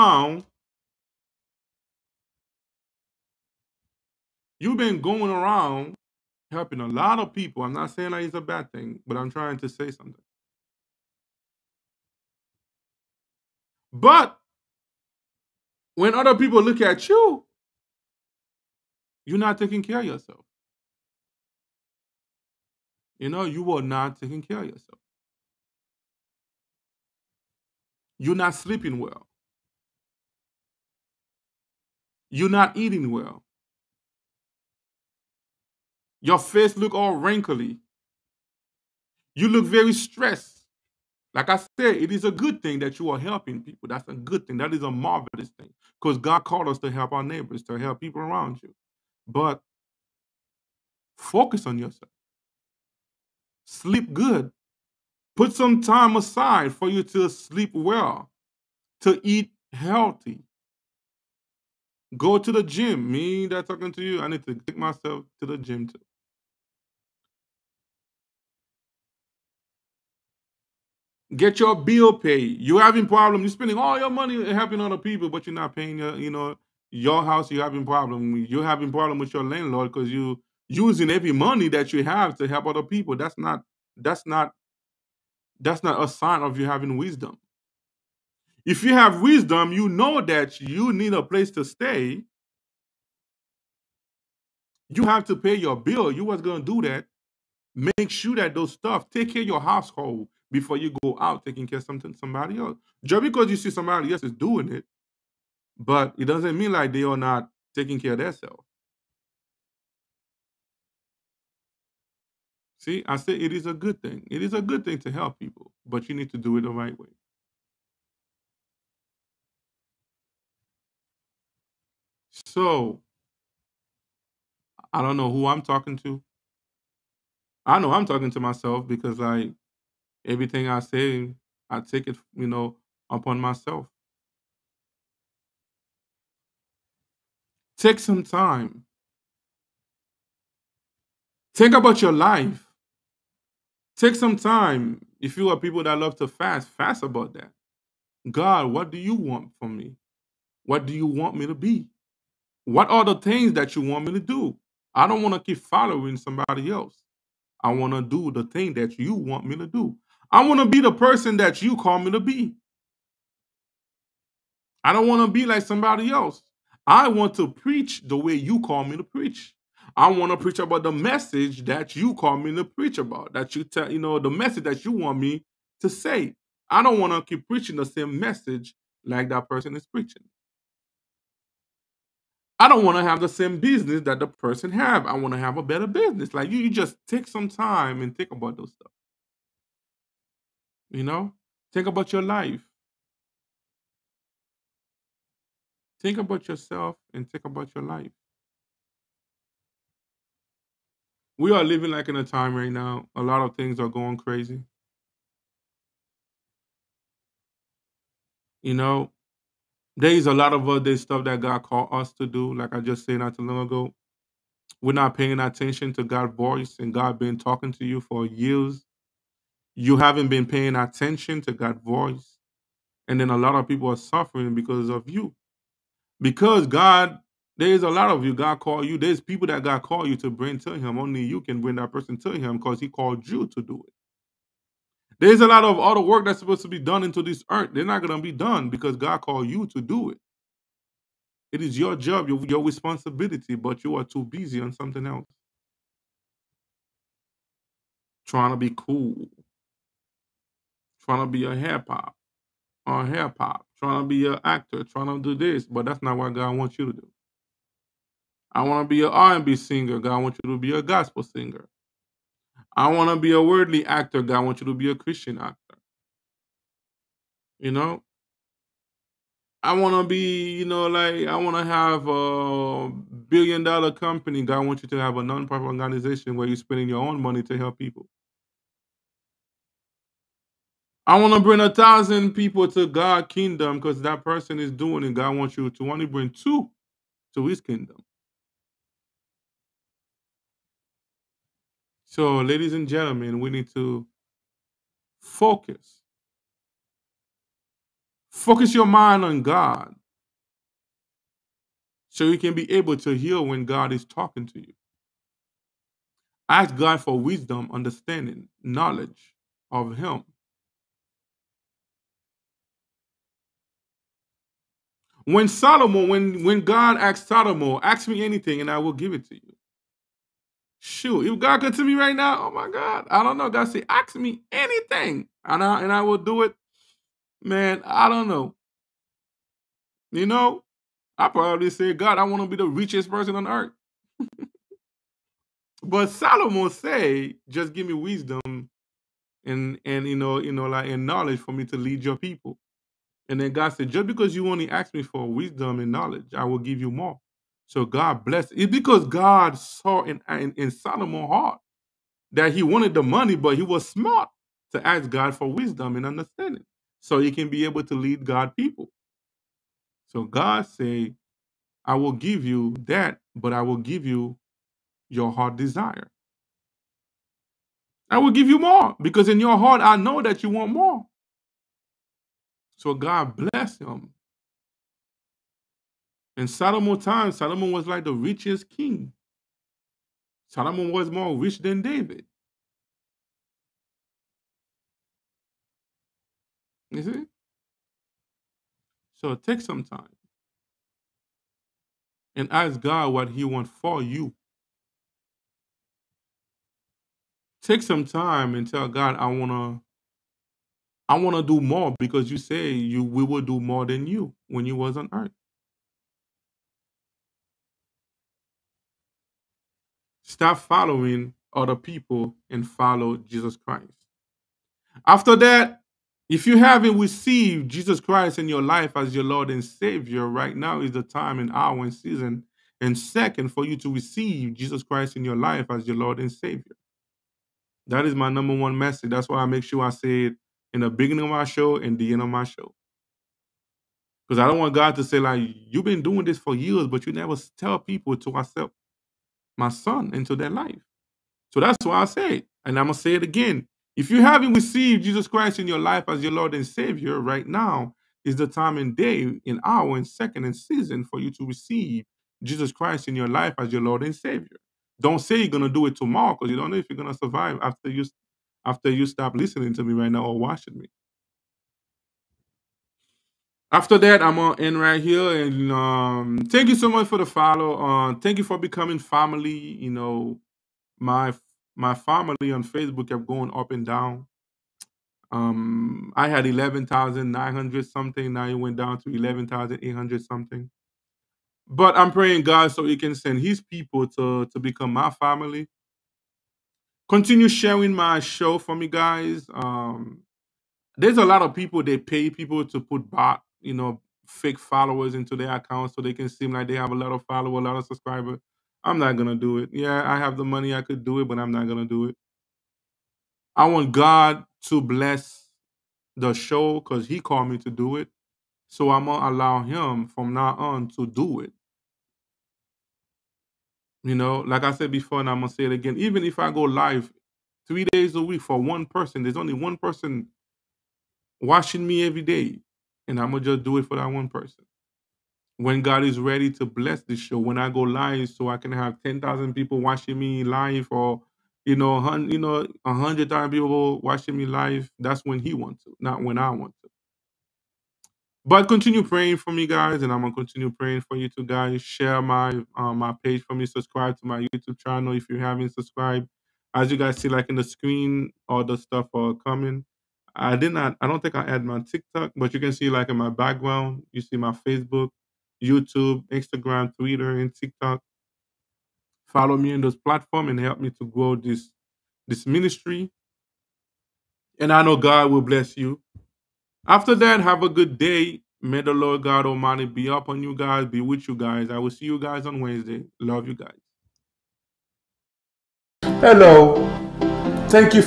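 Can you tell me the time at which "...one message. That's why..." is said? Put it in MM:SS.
07:08.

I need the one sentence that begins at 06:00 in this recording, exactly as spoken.
So God said, I will give you that, but I will give you your heart desire.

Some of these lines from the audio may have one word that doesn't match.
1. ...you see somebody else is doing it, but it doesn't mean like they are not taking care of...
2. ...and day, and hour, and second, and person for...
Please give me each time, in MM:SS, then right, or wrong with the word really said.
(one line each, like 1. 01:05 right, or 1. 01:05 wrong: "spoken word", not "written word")
1. 01:43 right
2. 07:28 wrong: "season", not "person".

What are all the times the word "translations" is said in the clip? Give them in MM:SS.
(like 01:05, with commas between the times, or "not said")
not said.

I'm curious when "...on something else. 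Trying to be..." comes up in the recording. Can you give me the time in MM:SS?
04:04.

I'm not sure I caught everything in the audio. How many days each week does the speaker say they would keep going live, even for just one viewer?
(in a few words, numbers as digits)
3.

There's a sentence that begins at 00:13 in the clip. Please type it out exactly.
But when other people look at you, you're not taking care of yourself.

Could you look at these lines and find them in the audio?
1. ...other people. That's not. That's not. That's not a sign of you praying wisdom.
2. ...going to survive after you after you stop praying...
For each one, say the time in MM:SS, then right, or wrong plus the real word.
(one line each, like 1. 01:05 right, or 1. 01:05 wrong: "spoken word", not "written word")
1. 01:22 wrong: "having", not "praying"
2. 07:36 wrong: "listening", not "praying".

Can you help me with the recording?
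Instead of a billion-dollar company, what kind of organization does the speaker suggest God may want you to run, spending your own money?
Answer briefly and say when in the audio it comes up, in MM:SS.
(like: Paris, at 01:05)
nonprofit organization, at 04:35.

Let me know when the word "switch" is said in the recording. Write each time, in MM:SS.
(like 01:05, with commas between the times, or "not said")
not said.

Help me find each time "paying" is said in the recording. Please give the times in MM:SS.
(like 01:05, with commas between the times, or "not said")
01:15, 03:35, 03:40.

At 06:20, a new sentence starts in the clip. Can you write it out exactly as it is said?
Solomon was more rich than David.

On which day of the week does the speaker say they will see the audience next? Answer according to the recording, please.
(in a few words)
Wednesday.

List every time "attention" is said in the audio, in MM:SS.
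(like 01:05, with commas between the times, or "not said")
03:35, 03:40.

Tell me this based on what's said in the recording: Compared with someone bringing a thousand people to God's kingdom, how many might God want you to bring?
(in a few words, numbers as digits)
2.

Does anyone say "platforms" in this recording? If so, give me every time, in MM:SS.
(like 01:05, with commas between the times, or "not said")
09:19.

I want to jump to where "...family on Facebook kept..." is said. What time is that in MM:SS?
07:51.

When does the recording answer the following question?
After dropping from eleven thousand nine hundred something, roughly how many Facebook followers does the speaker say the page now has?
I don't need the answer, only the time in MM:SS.
07:59.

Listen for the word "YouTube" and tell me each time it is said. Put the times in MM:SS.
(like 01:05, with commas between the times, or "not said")
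09:04, 09:15.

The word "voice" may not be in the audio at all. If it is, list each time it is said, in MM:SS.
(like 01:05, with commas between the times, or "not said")
03:36, 03:41.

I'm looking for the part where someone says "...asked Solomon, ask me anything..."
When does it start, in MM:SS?
05:16.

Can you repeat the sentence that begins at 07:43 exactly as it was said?
After that, I'm gonna end right here, and um, thank you so much for the follow.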